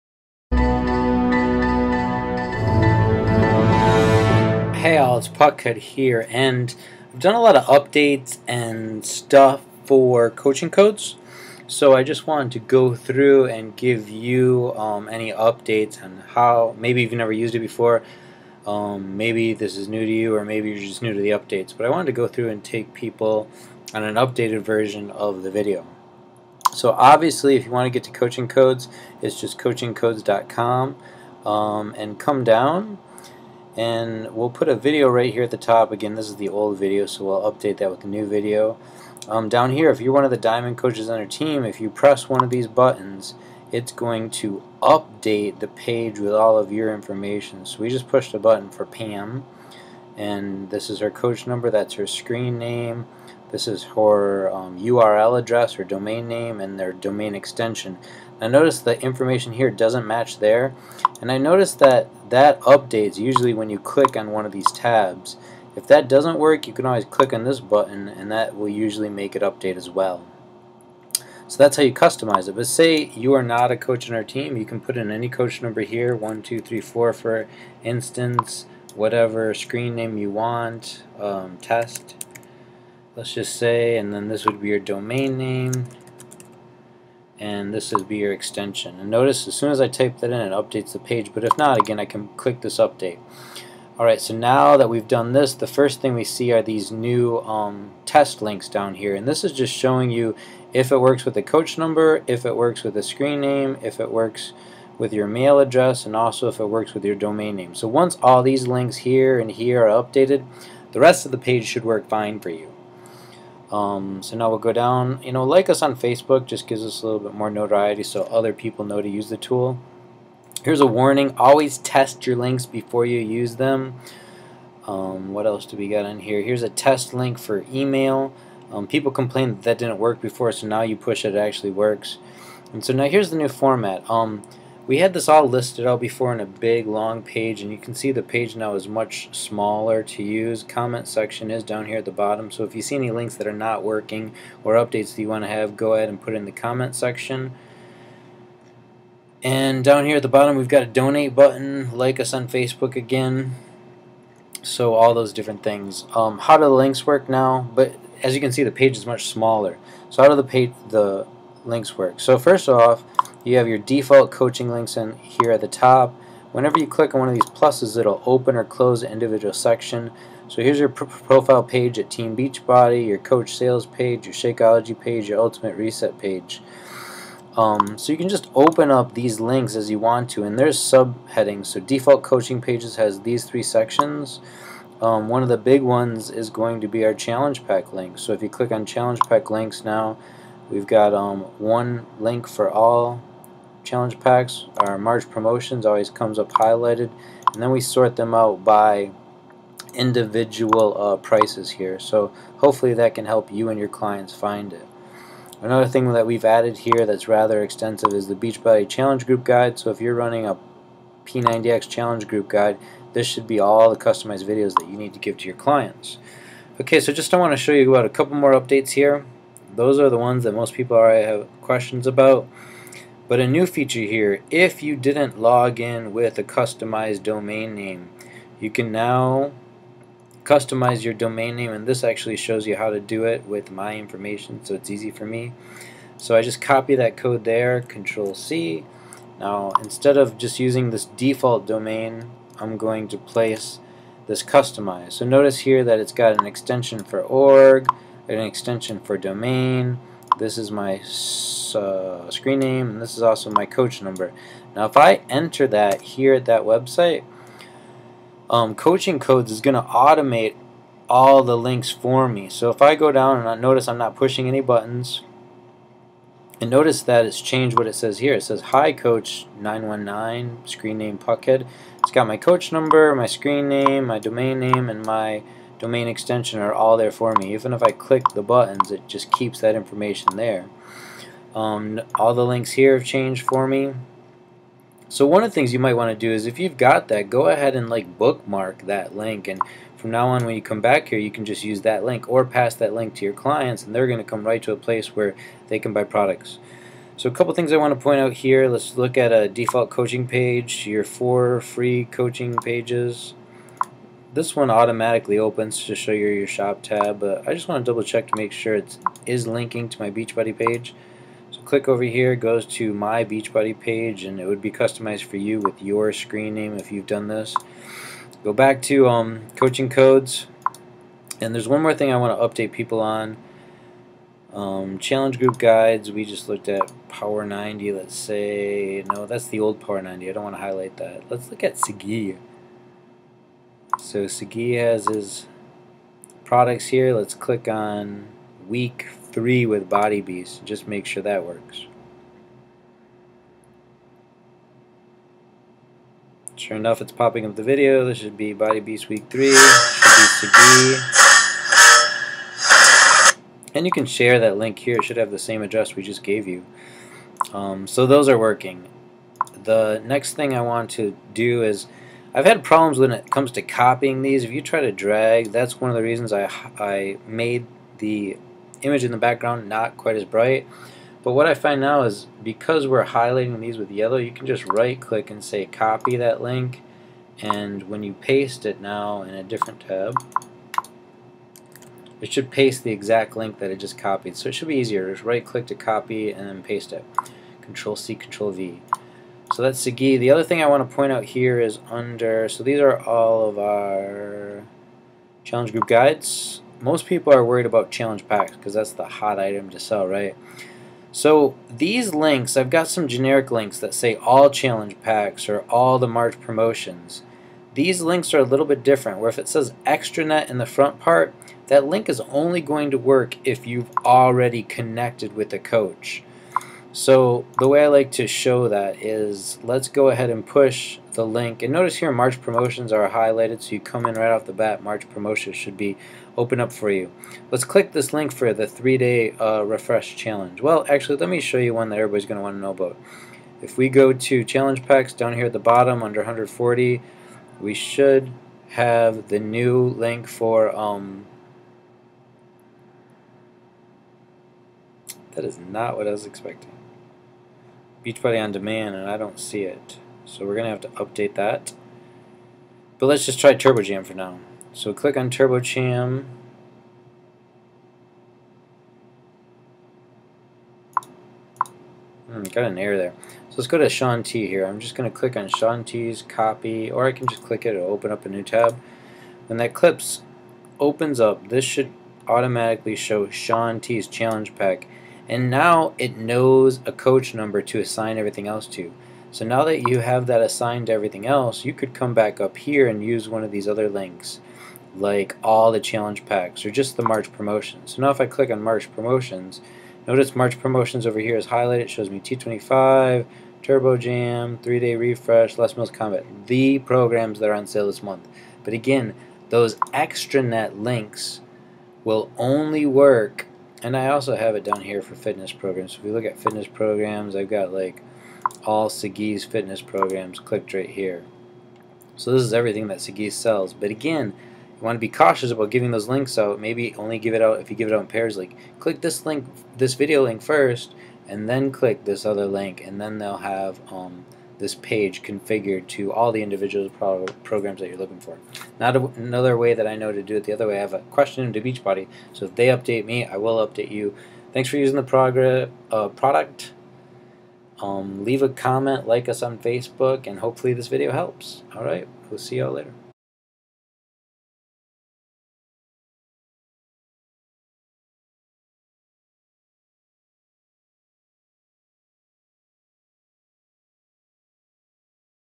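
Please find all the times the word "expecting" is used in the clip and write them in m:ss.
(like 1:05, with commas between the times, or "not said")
7:26.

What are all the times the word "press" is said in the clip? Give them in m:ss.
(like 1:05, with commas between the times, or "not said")
0:41.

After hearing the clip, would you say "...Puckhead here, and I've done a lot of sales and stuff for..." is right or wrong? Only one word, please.
wrong.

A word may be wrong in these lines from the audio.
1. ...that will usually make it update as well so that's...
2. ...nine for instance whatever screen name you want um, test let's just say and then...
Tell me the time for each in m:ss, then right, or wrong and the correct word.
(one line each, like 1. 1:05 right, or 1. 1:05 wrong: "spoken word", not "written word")
1. 1:08 right
2. 1:16 wrong: "four", not "nine".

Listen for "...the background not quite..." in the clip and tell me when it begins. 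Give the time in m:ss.
6:09.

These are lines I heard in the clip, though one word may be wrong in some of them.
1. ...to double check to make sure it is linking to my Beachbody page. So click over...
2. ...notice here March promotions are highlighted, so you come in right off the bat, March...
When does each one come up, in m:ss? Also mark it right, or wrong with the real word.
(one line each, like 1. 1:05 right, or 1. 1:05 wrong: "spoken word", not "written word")
1. 5:07 right
2. 7:01 right.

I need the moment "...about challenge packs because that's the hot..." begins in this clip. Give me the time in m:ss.
6:37.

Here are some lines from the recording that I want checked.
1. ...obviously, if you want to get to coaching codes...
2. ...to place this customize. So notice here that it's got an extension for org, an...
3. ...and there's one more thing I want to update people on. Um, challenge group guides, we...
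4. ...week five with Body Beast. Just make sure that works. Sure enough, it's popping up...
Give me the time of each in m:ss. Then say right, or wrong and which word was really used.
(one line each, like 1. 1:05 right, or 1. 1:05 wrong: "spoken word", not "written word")
1. 0:26 right
2. 4:03 right
3. 5:21 right
4. 5:38 wrong: "three", not "five".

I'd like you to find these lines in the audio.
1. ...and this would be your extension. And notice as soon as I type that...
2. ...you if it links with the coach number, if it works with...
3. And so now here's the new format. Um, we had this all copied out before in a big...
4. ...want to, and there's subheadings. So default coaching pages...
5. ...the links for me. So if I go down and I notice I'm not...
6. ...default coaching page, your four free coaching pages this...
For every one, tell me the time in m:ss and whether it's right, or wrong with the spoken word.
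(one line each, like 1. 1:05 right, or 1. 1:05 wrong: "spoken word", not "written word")
1. 1:27 right
2. 1:40 wrong: "works", not "links"
3. 2:12 wrong: "listed", not "copied"
4. 2:59 right
5. 4:21 right
6. 4:59 right.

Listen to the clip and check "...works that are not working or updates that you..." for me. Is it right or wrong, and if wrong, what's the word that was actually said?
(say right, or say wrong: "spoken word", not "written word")
wrong: "links", not "works".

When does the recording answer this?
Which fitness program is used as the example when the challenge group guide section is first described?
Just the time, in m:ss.
3:31.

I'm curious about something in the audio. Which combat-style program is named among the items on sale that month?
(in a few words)
Les Mills Combat.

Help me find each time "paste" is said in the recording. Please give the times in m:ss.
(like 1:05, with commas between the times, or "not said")
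6:18, 6:22, 6:26.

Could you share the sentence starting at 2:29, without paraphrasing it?
And down here at the bottom we've got a donate button, like us on Facebook again, so all those different things.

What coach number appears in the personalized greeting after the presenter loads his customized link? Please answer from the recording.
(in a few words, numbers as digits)
919.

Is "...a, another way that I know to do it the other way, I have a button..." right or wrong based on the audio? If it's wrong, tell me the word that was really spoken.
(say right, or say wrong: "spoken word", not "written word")
wrong: "question", not "button".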